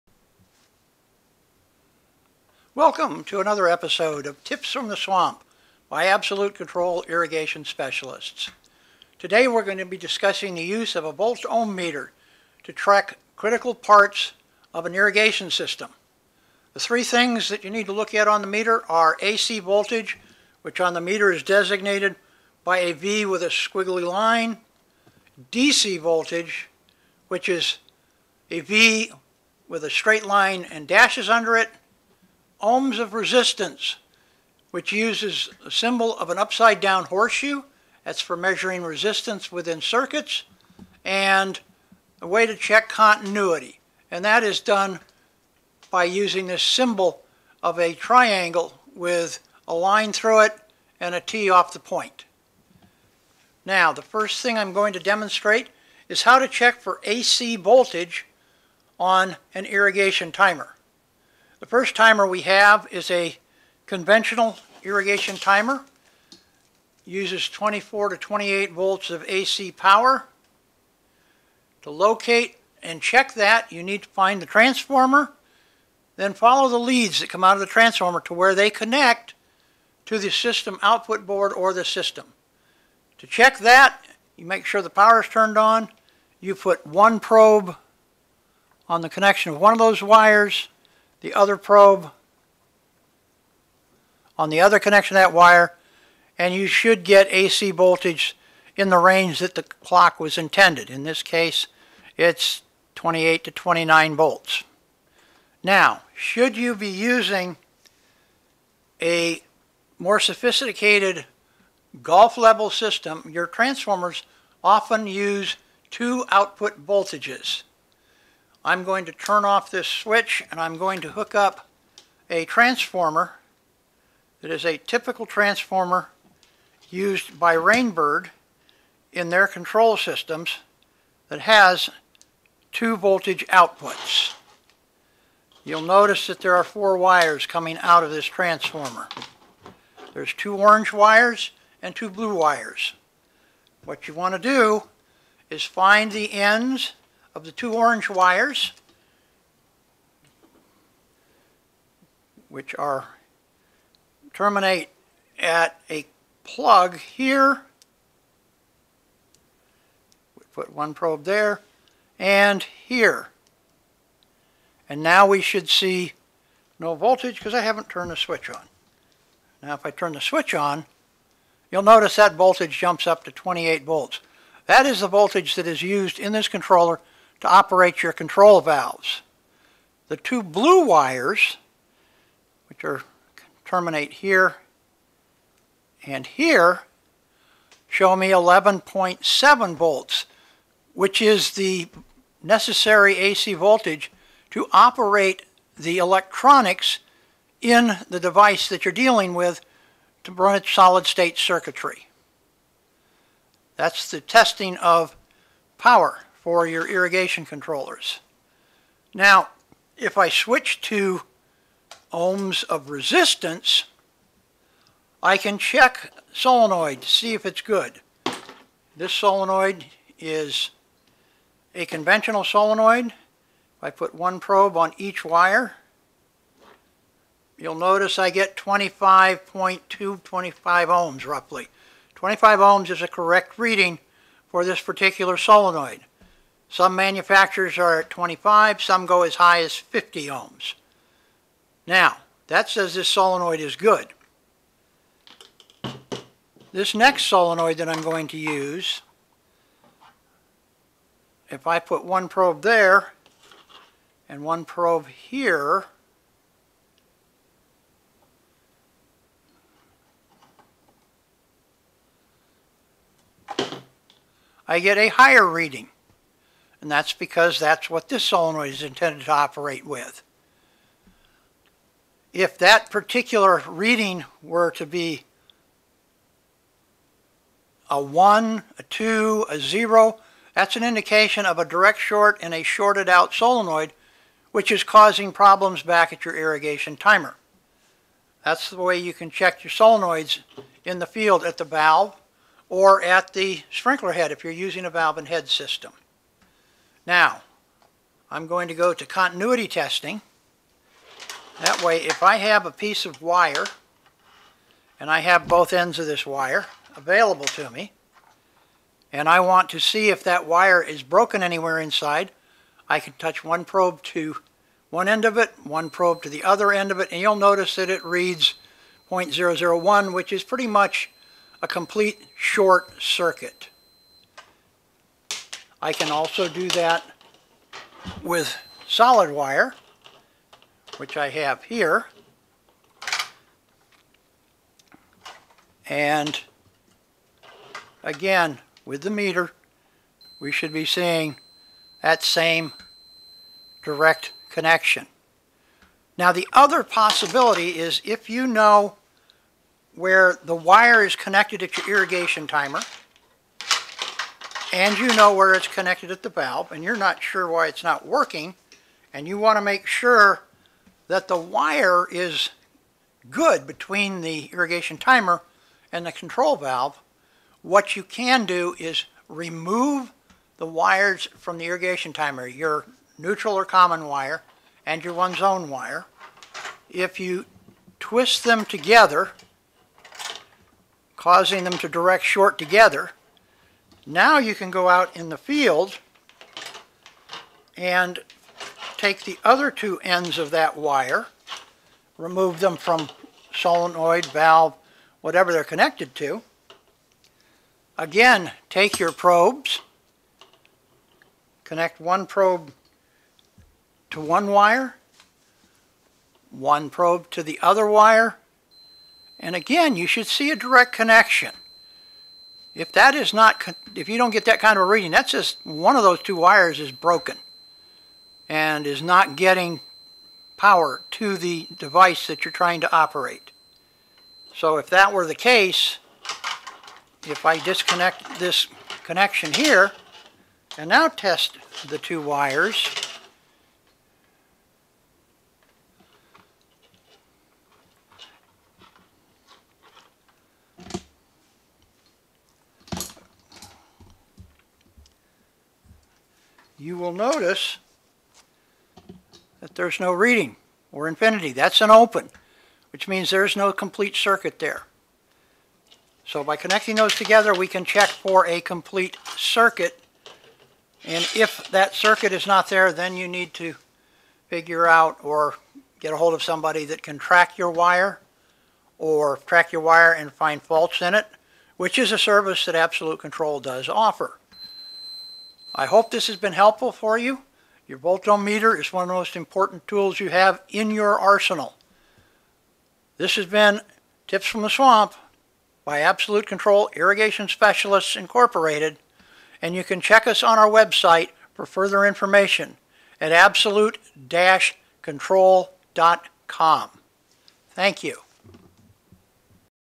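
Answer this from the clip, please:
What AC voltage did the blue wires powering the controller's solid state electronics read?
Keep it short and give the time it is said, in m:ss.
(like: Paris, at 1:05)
11.7 volts, at 3:08.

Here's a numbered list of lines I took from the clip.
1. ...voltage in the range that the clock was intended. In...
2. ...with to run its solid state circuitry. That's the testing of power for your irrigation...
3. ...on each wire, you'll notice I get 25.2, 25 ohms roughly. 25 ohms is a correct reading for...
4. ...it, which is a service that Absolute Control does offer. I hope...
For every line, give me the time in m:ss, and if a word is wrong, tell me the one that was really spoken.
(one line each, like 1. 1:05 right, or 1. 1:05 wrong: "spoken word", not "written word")
1. 1:37 right
2. 3:19 right
3. 3:44 right
4. 7:51 right.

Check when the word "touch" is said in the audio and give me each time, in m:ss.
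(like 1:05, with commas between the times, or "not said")
5:13.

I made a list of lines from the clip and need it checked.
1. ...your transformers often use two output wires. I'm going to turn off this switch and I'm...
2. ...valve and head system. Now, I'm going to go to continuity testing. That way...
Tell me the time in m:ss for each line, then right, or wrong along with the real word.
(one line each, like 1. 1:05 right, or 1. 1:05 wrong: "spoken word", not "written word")
1. 1:53 wrong: "voltages", not "wires"
2. 4:54 right.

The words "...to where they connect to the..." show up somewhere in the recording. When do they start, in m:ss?
1:18.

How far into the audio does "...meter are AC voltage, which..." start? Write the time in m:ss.
0:18.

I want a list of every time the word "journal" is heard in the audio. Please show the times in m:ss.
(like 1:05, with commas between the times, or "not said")
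not said.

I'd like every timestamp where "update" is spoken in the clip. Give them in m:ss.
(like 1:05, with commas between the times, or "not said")
not said.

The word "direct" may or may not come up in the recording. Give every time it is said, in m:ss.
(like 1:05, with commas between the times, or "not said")
4:41, 5:43, 6:21, 6:50.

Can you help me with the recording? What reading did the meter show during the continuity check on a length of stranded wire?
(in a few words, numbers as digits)
0.001.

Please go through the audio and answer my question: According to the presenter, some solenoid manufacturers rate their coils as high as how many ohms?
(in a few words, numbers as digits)
50 ohms.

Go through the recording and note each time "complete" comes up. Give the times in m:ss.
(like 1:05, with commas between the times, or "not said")
5:21, 7:33, 7:38.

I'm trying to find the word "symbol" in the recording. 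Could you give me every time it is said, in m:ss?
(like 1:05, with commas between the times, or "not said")
0:35, 0:46.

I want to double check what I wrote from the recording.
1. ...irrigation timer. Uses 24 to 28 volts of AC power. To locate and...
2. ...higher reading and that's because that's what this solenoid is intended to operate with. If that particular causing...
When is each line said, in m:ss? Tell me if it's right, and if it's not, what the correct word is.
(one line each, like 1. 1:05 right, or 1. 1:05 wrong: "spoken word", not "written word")
1. 1:04 right
2. 4:25 wrong: "reading", not "causing".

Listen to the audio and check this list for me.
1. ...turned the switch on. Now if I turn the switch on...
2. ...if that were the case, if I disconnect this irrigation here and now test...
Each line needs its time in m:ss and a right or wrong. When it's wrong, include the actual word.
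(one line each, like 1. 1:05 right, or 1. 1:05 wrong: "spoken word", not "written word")
1. 2:47 right
2. 7:04 wrong: "connection", not "irrigation".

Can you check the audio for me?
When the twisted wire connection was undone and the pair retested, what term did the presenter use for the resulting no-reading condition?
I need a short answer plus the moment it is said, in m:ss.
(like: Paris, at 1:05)
An open, at 7:31.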